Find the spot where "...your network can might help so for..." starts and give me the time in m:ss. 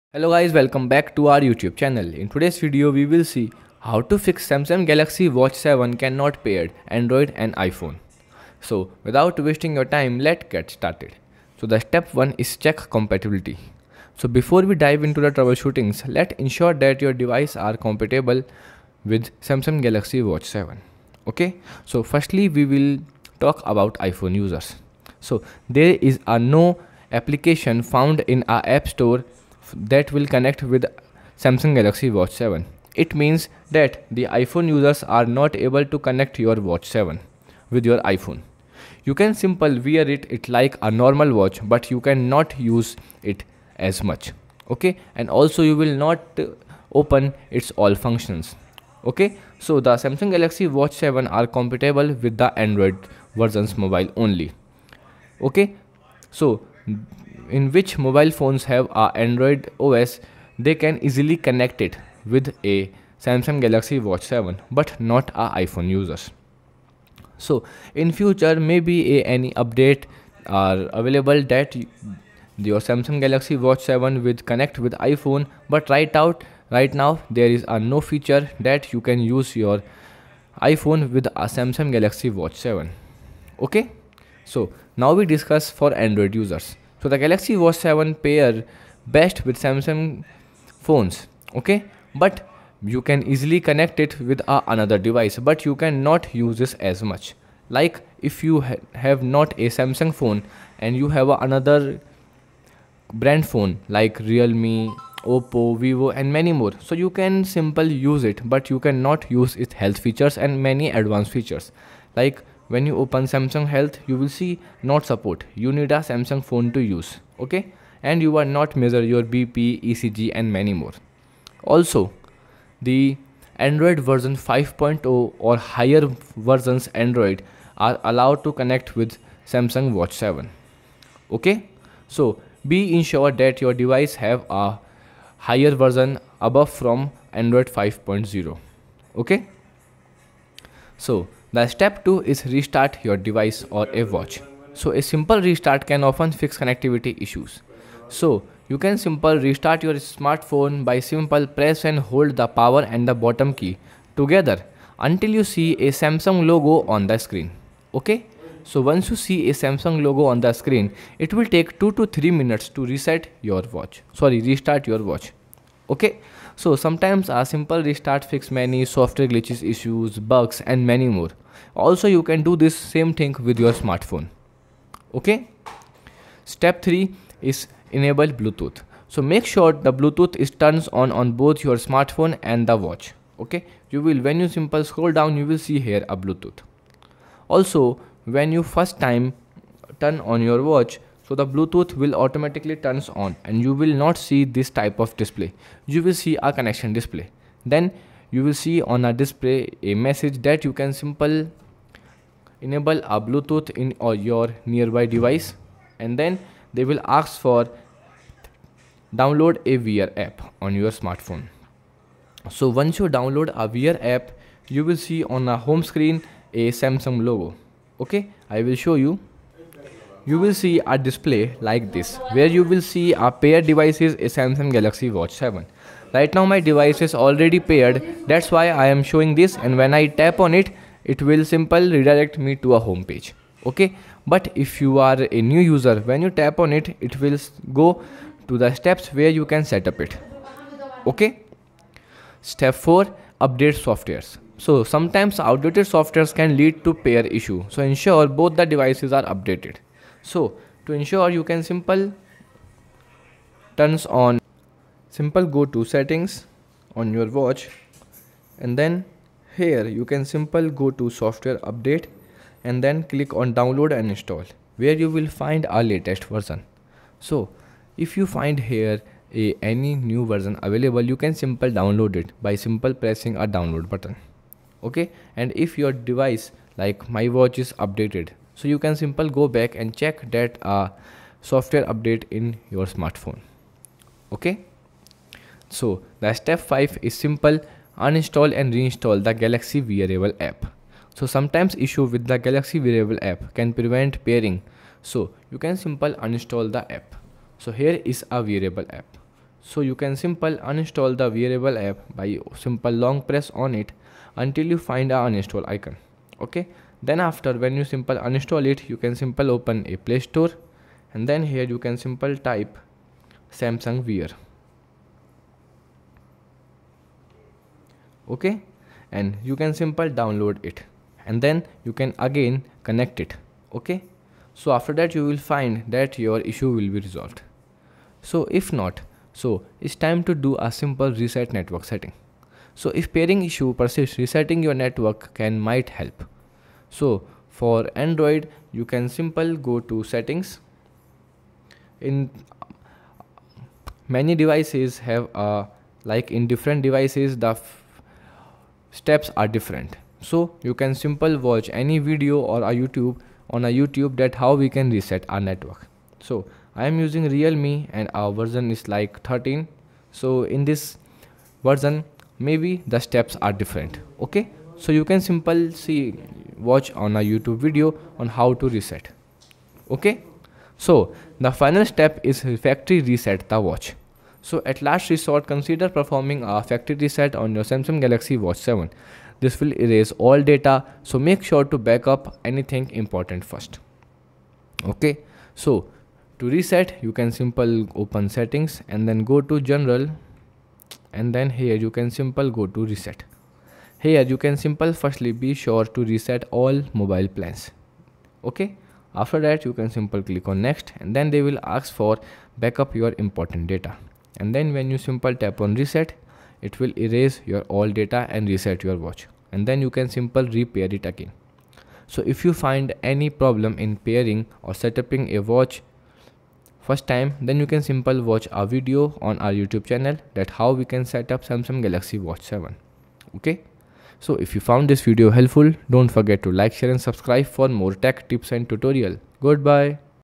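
5:34.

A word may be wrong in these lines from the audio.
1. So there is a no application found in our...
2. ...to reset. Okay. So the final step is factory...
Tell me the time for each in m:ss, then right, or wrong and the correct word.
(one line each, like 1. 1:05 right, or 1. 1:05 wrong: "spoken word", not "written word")
1. 0:25 right
2. 6:08 right.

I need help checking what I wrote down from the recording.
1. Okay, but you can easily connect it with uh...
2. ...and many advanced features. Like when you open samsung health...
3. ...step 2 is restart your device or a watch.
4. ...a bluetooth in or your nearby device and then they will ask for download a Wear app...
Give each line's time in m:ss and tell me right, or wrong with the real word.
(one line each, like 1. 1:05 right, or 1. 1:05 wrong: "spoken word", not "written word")
1. 1:31 right
2. 1:50 right
3. 2:21 right
4. 3:23 right.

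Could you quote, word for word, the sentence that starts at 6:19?
This will erase all data so make sure to back up anything important first.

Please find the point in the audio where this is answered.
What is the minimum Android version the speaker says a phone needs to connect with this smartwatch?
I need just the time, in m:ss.
2:03.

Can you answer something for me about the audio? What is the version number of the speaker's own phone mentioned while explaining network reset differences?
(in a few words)
13.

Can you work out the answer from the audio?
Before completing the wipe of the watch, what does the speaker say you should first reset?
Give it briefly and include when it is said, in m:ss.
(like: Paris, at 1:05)
All mobile plans, at 6:36.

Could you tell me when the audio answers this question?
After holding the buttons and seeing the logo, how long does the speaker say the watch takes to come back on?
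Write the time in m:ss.
2:41.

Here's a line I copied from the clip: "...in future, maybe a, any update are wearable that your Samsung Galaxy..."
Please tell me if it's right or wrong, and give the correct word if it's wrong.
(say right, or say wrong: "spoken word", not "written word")
wrong: "available", not "wearable".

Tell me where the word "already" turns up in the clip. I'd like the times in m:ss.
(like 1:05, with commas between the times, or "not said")
3:47.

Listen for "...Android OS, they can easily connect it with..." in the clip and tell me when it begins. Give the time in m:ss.
0:59.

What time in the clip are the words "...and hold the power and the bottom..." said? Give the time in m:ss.
2:31.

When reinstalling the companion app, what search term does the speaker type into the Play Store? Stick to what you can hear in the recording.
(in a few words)
Samsung Wear.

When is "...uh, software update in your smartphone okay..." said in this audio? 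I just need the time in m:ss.
4:40.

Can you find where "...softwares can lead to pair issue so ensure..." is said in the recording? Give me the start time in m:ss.
4:05.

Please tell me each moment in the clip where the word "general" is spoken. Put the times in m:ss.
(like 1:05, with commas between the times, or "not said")
6:29.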